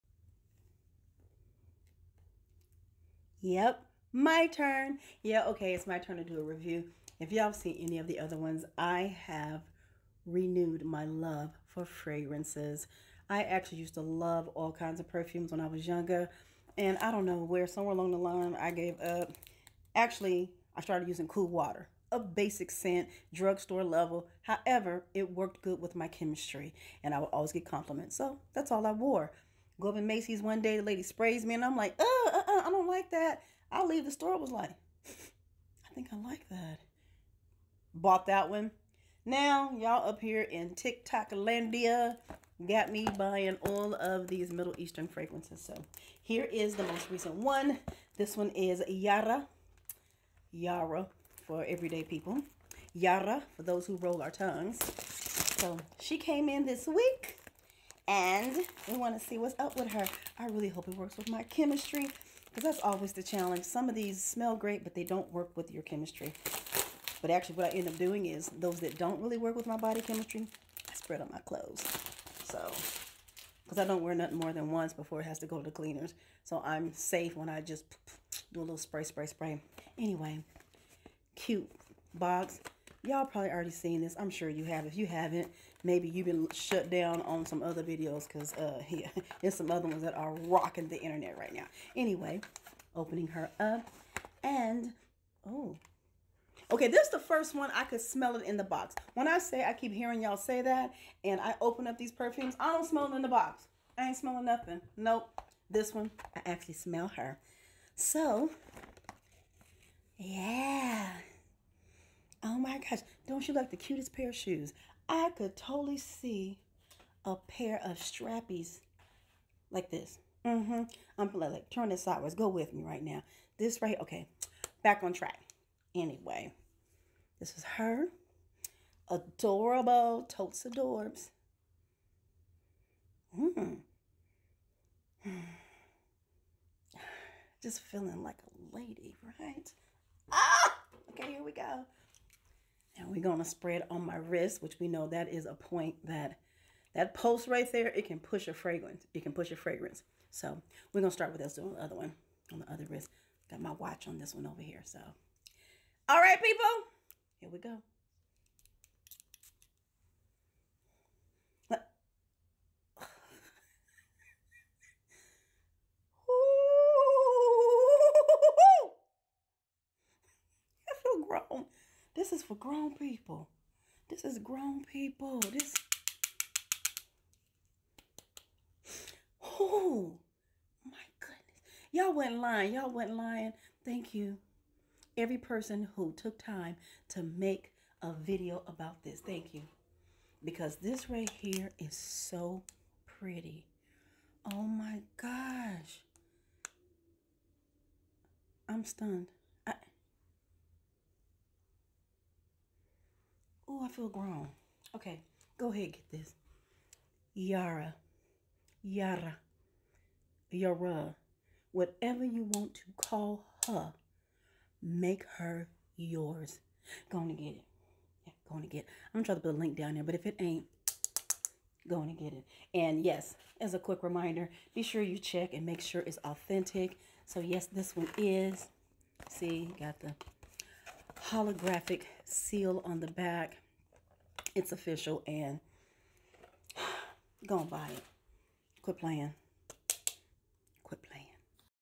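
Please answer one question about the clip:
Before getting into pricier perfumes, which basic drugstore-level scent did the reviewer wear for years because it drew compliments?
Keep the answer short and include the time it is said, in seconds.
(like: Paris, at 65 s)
Cool Water, at 21 s.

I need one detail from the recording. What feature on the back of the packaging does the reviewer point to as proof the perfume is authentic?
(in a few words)
holographic seal.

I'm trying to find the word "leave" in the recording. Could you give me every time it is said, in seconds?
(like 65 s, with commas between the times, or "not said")
33 s.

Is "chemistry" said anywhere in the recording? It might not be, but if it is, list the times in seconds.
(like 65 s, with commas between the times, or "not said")
26 s, 61 s, 65 s, 70 s.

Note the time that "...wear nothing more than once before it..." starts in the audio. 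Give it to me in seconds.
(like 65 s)
74 s.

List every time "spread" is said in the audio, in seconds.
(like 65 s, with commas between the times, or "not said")
70 s, 143 s.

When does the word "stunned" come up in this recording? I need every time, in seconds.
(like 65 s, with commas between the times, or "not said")
198 s.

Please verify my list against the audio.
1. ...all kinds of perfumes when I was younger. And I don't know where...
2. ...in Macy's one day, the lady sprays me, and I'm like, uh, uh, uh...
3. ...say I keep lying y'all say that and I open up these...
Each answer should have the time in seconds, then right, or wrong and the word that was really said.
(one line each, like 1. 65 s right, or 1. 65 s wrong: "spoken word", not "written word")
1. 14 s right
2. 29 s right
3. 99 s wrong: "hearing", not "lying".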